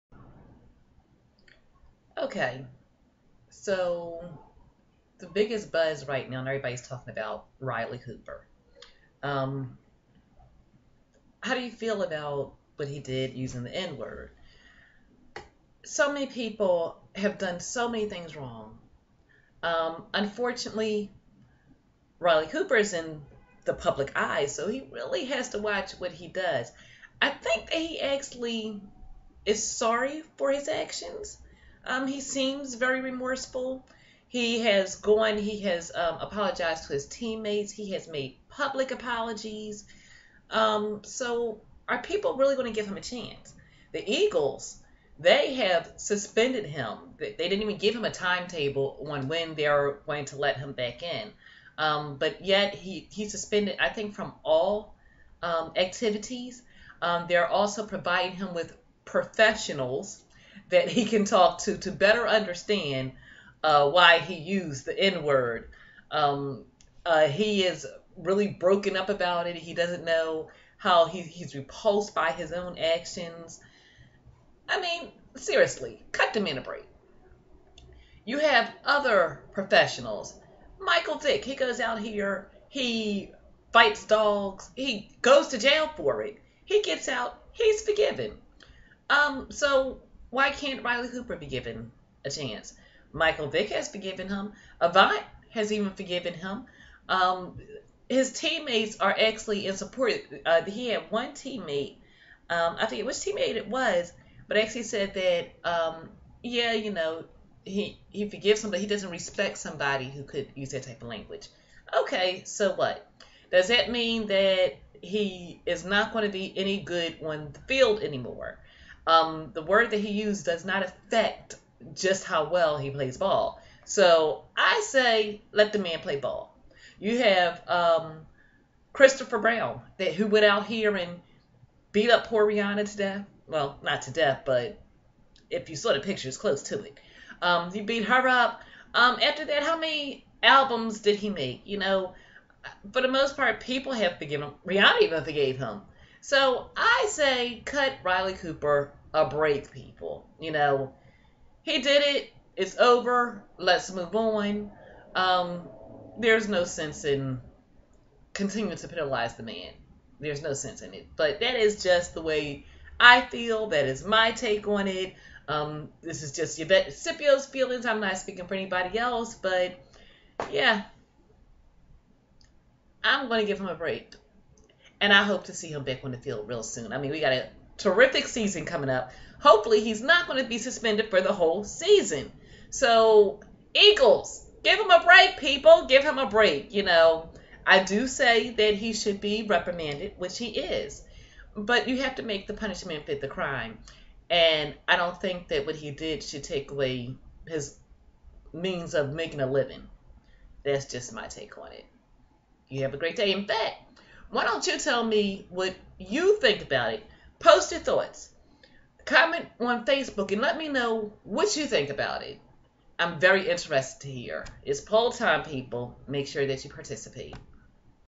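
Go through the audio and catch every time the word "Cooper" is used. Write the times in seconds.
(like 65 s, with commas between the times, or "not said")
7 s, 22 s, 91 s, 148 s.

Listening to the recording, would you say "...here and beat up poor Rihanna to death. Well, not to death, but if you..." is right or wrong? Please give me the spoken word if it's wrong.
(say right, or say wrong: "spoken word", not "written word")
right.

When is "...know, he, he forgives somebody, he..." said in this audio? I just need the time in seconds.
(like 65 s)
106 s.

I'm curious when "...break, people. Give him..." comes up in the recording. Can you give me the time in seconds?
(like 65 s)
185 s.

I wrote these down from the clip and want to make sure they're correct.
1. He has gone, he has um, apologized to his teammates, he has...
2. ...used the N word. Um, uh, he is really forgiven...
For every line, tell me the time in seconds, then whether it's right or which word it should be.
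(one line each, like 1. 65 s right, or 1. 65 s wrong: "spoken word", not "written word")
1. 34 s right
2. 64 s wrong: "broken", not "forgiven".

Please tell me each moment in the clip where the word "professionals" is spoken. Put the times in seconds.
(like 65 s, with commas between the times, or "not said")
59 s, 79 s.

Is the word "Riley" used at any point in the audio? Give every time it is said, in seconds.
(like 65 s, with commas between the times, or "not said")
7 s, 22 s, 90 s, 148 s.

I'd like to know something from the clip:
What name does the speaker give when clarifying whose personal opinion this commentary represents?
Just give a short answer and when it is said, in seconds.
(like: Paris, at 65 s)
Yvette Scipio, at 166 s.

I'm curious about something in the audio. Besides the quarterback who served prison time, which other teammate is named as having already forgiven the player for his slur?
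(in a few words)
Avant.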